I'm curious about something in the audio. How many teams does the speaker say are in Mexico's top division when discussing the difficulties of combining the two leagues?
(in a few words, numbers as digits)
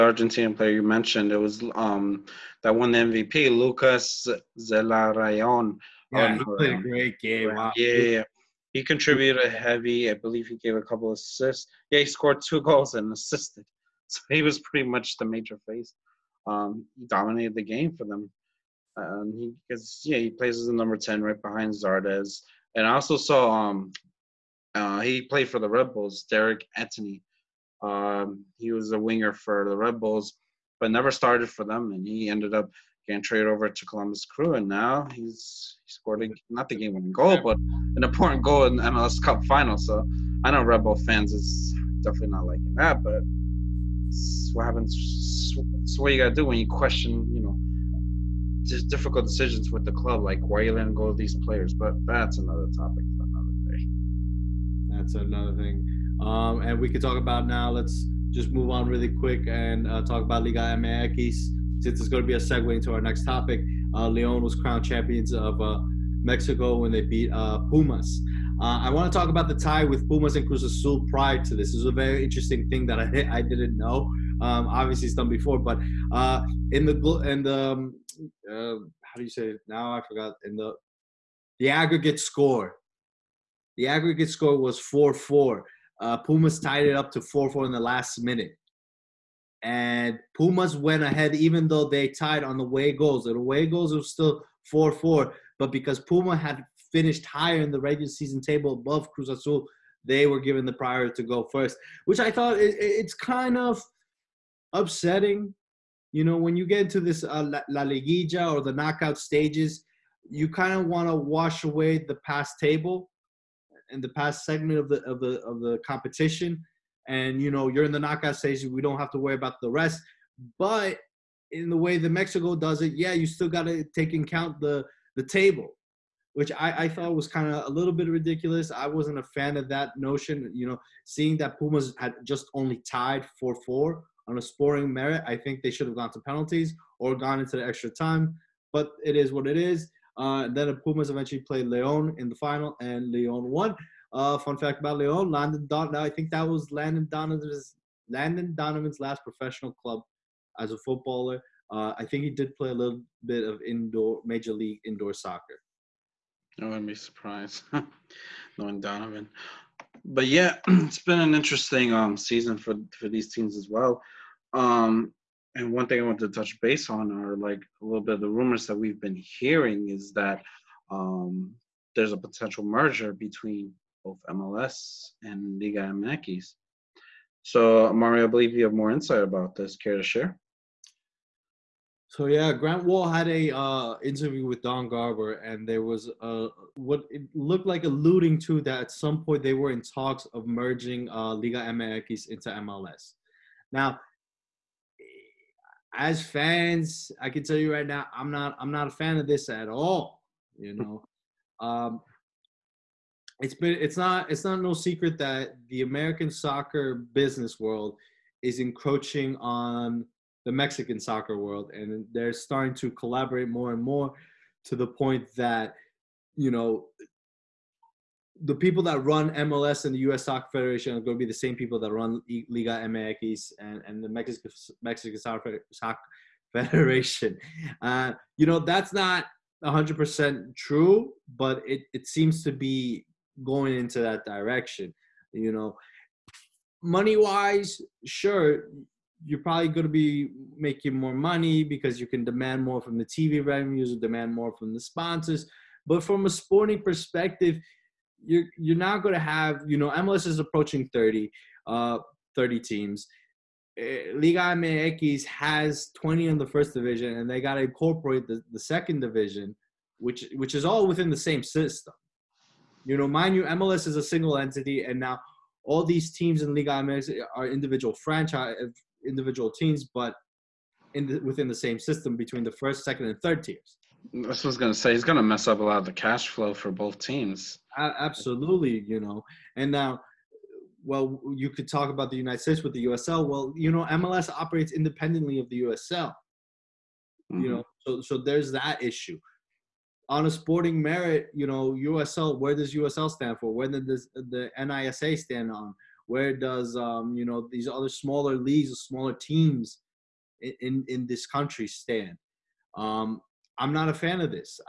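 20.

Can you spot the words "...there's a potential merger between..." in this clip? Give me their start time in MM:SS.
02:51.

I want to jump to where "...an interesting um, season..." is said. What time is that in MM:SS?
02:41.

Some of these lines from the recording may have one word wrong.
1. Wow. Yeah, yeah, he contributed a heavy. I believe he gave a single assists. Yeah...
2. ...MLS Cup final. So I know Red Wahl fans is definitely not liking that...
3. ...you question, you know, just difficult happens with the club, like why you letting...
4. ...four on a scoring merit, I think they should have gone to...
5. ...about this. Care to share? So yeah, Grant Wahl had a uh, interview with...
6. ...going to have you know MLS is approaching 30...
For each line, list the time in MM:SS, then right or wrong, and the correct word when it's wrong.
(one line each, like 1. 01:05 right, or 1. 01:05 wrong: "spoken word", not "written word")
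1. 00:07 wrong: "couple", not "single"
2. 00:38 wrong: "Bull", not "Wahl"
3. 00:46 wrong: "decisions", not "happens"
4. 02:13 right
5. 02:59 right
6. 04:09 right.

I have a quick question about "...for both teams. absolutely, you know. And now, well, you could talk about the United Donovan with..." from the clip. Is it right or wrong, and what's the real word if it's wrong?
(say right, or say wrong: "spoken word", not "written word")
wrong: "States", not "Donovan".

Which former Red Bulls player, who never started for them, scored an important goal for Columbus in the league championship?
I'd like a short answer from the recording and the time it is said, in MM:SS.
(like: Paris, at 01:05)
Derrick Etienne, at 00:26.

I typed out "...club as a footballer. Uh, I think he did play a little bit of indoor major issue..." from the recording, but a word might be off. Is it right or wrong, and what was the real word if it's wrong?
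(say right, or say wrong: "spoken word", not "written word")
wrong: "league", not "issue".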